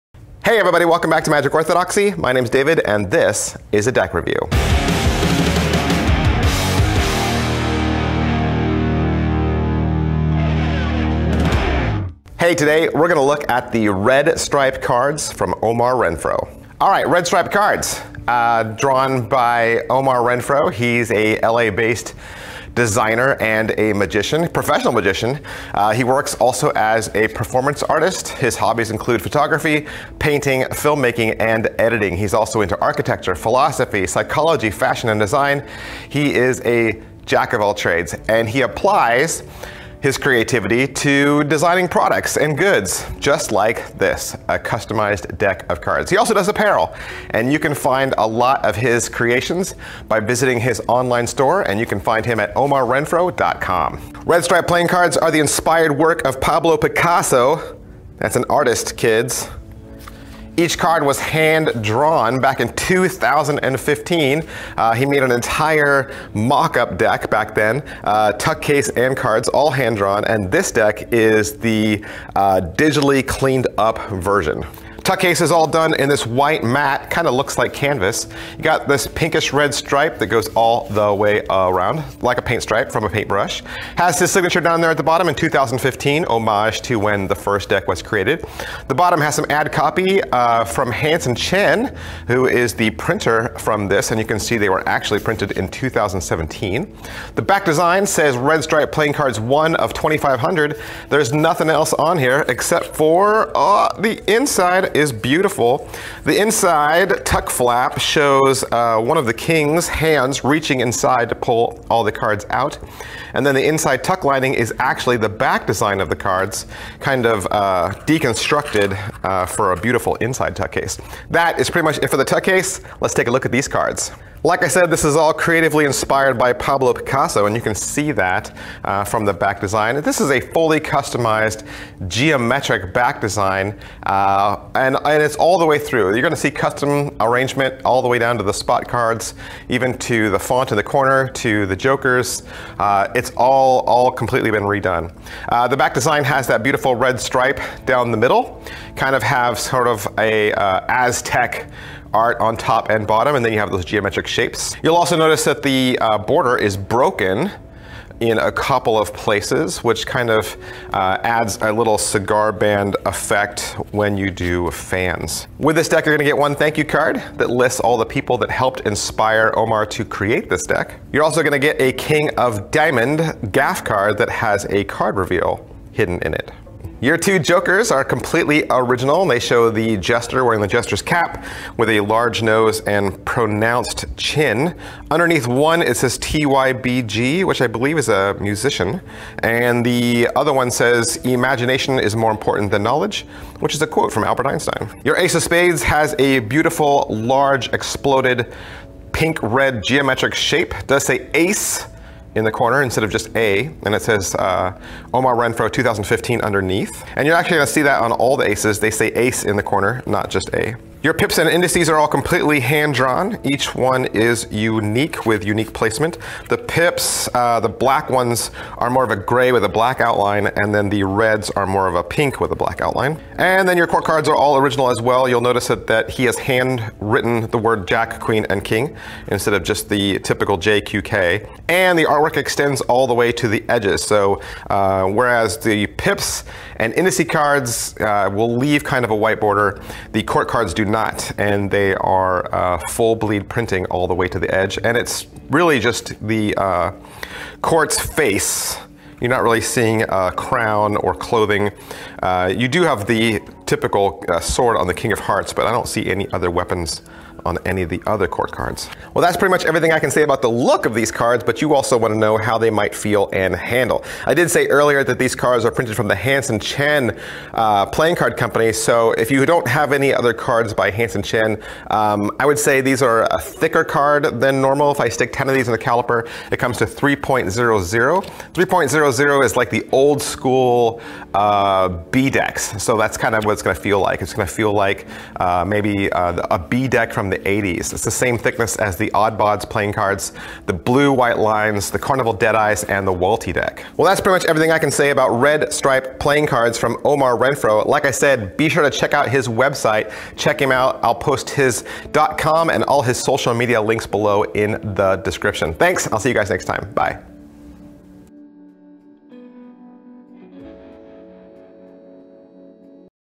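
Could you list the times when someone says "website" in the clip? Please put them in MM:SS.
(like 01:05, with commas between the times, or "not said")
04:59.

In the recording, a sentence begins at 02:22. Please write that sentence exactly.
Uh, it's all, all completely been redone.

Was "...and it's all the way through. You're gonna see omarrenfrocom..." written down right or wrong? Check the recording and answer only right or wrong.
wrong.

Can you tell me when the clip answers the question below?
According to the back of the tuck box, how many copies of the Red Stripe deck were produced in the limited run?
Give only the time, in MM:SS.
01:39.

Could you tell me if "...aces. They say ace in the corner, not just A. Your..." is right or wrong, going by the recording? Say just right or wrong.
right.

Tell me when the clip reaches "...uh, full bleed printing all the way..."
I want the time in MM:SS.
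04:02.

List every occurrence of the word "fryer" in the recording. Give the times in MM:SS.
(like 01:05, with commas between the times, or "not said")
not said.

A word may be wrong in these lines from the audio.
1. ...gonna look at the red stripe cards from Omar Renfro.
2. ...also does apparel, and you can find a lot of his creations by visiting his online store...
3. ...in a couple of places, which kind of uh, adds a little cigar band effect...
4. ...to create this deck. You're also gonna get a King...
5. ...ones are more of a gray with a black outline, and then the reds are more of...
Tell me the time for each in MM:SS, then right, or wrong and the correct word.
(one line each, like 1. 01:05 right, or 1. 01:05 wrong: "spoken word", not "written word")
1. 00:13 right
2. 00:46 right
3. 02:38 right
4. 02:49 right
5. 03:38 right.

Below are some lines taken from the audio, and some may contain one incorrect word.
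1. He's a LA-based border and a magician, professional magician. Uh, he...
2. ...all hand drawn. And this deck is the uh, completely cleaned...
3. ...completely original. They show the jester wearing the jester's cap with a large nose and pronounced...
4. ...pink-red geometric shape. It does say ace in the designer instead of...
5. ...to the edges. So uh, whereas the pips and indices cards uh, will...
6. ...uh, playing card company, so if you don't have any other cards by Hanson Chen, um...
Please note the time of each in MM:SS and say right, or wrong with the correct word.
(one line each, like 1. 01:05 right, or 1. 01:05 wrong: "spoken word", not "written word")
1. 00:20 wrong: "designer", not "border"
2. 01:09 wrong: "digitally", not "completely"
3. 02:58 right
4. 03:19 wrong: "corner", not "designer"
5. 03:53 right
6. 04:27 right.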